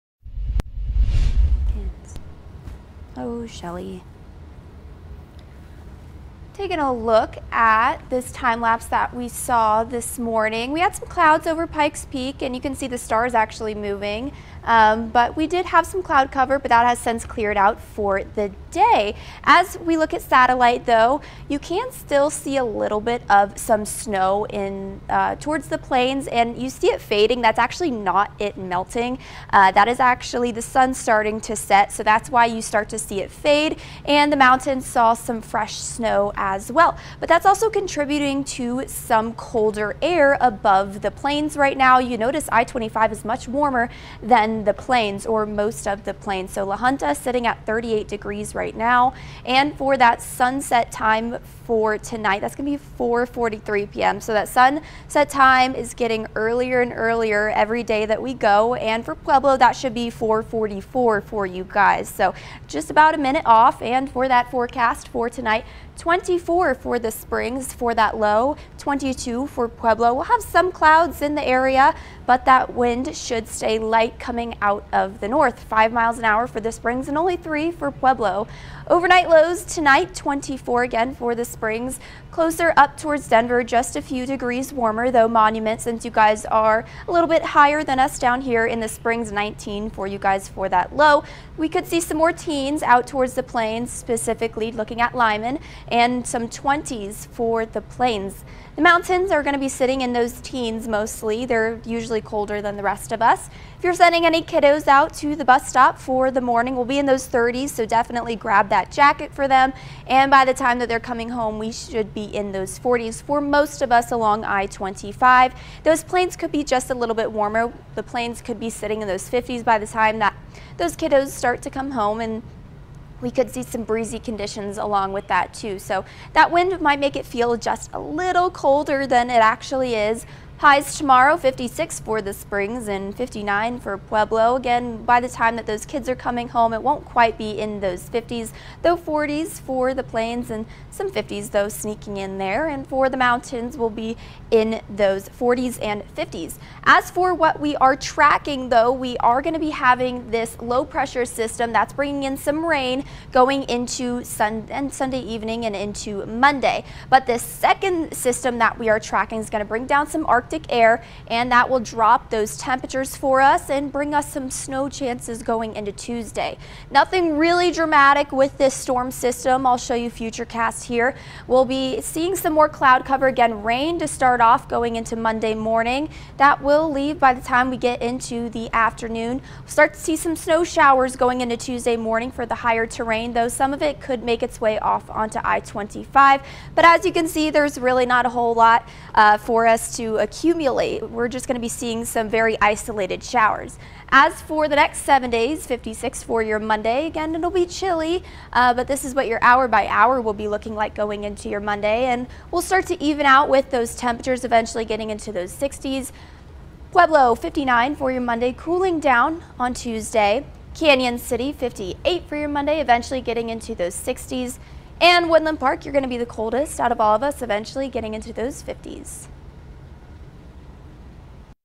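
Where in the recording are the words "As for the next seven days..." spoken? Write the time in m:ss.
3:14.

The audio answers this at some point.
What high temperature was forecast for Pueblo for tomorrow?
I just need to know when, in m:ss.
2:13.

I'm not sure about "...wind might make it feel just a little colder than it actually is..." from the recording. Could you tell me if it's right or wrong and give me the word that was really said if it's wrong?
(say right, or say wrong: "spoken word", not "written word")
right.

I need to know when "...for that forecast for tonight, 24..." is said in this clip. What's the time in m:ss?
1:04.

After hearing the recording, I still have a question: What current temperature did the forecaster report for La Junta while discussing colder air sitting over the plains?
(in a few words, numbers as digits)
38 degrees.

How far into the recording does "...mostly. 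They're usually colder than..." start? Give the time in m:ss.
1:40.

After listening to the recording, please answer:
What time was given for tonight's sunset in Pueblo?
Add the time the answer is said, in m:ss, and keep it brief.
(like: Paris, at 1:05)
4:44, at 1:00.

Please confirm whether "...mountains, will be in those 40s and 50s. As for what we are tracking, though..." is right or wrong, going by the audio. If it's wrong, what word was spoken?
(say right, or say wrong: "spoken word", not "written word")
right.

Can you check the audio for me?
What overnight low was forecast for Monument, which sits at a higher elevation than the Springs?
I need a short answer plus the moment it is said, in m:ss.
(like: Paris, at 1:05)
19, at 1:29.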